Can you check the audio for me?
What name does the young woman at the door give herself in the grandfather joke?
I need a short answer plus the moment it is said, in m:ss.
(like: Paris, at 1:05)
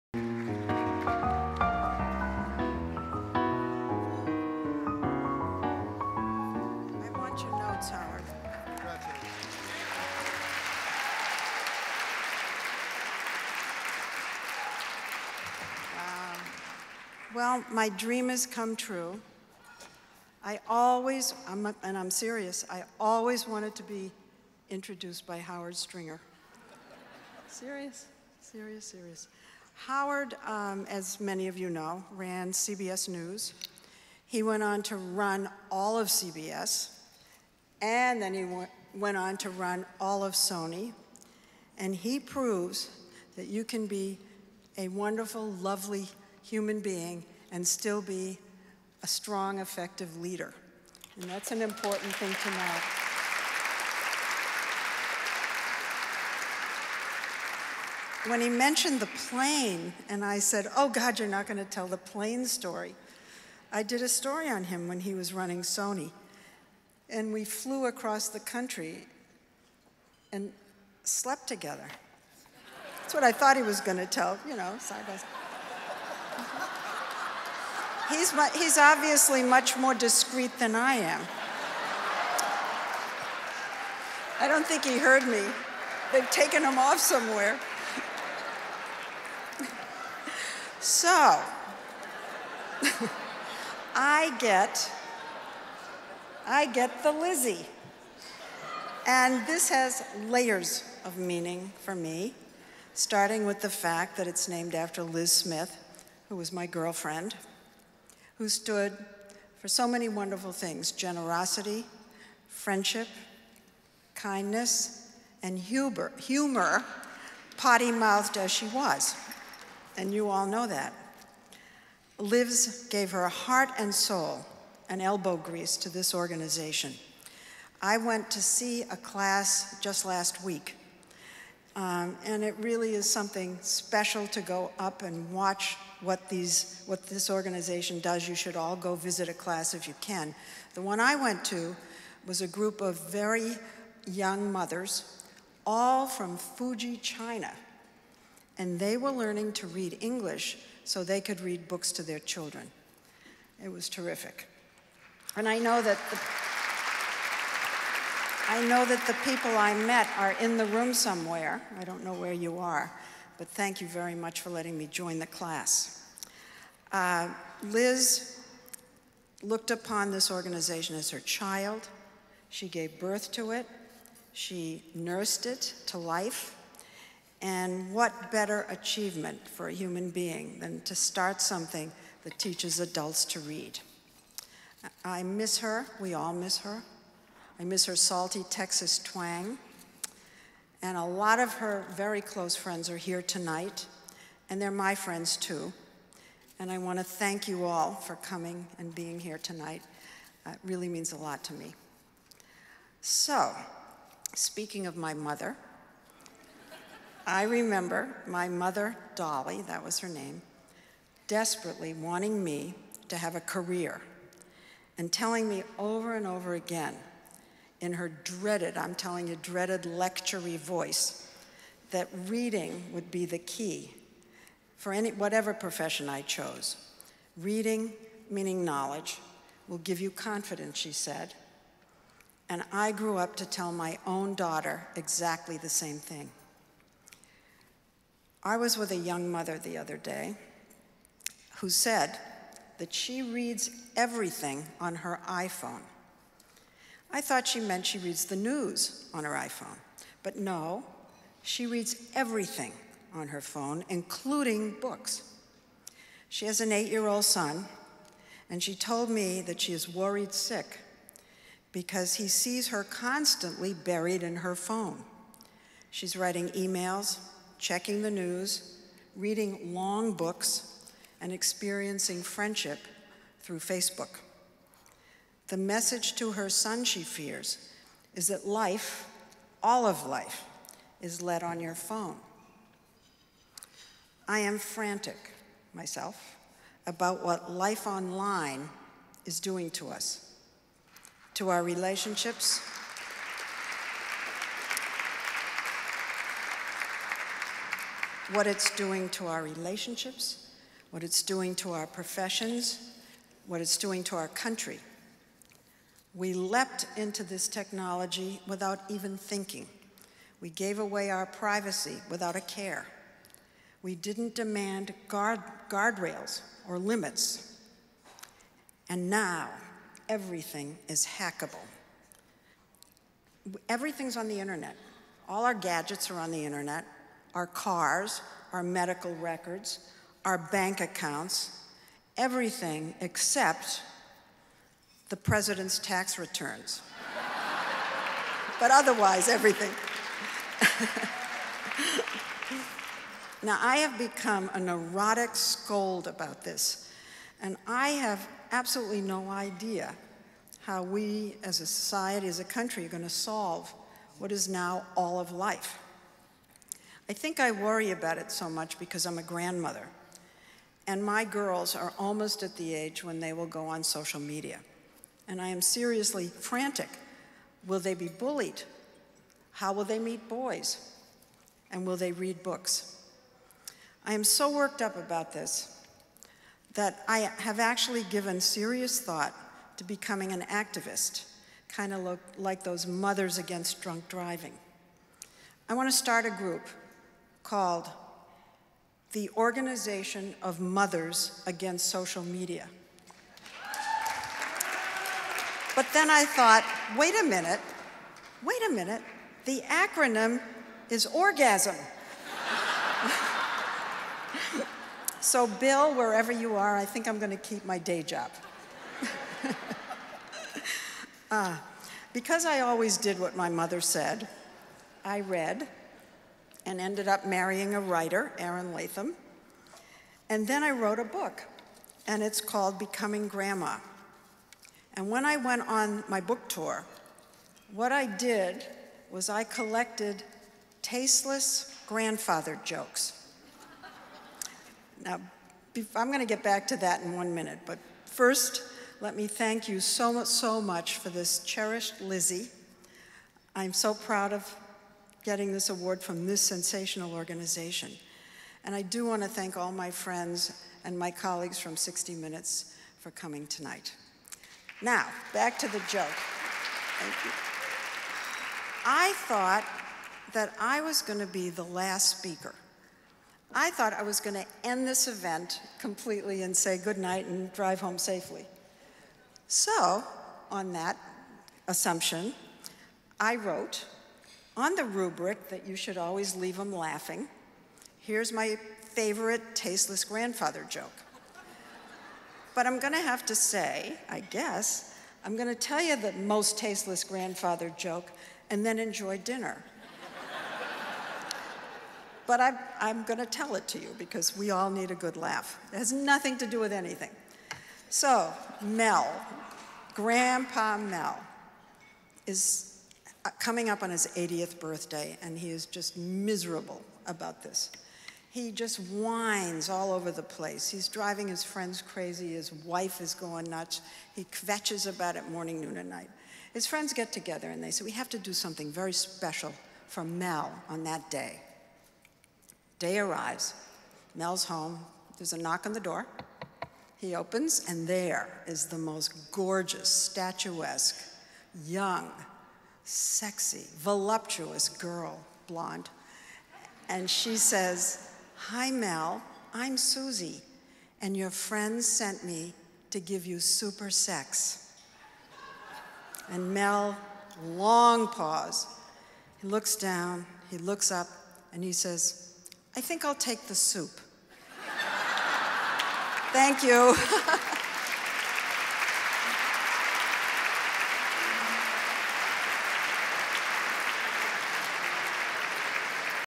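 Susie, at 8:59.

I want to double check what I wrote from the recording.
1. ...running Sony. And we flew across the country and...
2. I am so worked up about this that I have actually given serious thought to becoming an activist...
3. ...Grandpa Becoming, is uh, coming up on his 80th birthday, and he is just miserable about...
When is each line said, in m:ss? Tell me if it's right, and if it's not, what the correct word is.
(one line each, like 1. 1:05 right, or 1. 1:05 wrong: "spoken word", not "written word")
1. 1:05 right
2. 6:14 right
3. 8:19 wrong: "Mel", not "Becoming".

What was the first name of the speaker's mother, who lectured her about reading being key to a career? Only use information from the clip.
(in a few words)
Dolly.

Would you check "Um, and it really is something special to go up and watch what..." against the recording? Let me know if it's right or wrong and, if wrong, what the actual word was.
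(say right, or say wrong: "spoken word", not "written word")
right.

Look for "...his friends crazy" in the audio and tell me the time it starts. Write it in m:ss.
8:31.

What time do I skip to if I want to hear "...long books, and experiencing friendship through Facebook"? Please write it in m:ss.
4:29.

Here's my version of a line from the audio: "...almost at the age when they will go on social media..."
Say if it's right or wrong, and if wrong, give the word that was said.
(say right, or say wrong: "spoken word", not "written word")
right.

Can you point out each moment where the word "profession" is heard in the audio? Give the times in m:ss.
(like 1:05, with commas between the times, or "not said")
3:45, 5:01.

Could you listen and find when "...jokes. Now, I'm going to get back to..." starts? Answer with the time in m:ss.
7:12.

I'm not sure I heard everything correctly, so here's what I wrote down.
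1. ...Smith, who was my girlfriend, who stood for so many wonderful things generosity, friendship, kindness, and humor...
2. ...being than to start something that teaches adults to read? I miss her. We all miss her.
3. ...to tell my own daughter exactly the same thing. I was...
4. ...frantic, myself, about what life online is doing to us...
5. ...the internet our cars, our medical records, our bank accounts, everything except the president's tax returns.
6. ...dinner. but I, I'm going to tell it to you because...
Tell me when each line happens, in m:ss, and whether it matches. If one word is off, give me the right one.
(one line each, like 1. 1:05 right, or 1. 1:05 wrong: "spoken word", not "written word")
1. 1:45 right
2. 3:00 right
3. 3:53 right
4. 4:44 right
5. 5:26 right
6. 8:09 right.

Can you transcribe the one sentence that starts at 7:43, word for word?
I thought I was going to end this event completely and say goodnight and drive home safely.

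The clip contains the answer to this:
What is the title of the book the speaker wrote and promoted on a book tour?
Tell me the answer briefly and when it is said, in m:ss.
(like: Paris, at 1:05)
Becoming Grandma, at 7:02.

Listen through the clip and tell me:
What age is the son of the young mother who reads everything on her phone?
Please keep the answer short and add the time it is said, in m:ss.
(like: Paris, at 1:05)
8, at 4:16.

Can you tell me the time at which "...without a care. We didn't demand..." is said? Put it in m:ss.
5:12.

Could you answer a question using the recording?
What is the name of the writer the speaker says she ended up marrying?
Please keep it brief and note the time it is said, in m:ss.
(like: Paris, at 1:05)
Aaron Latham, at 6:58.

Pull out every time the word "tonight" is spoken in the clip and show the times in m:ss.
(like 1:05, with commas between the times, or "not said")
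3:13, 3:19, 7:33.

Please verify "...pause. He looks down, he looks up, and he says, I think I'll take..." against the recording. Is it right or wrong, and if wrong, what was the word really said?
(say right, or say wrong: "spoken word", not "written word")
right.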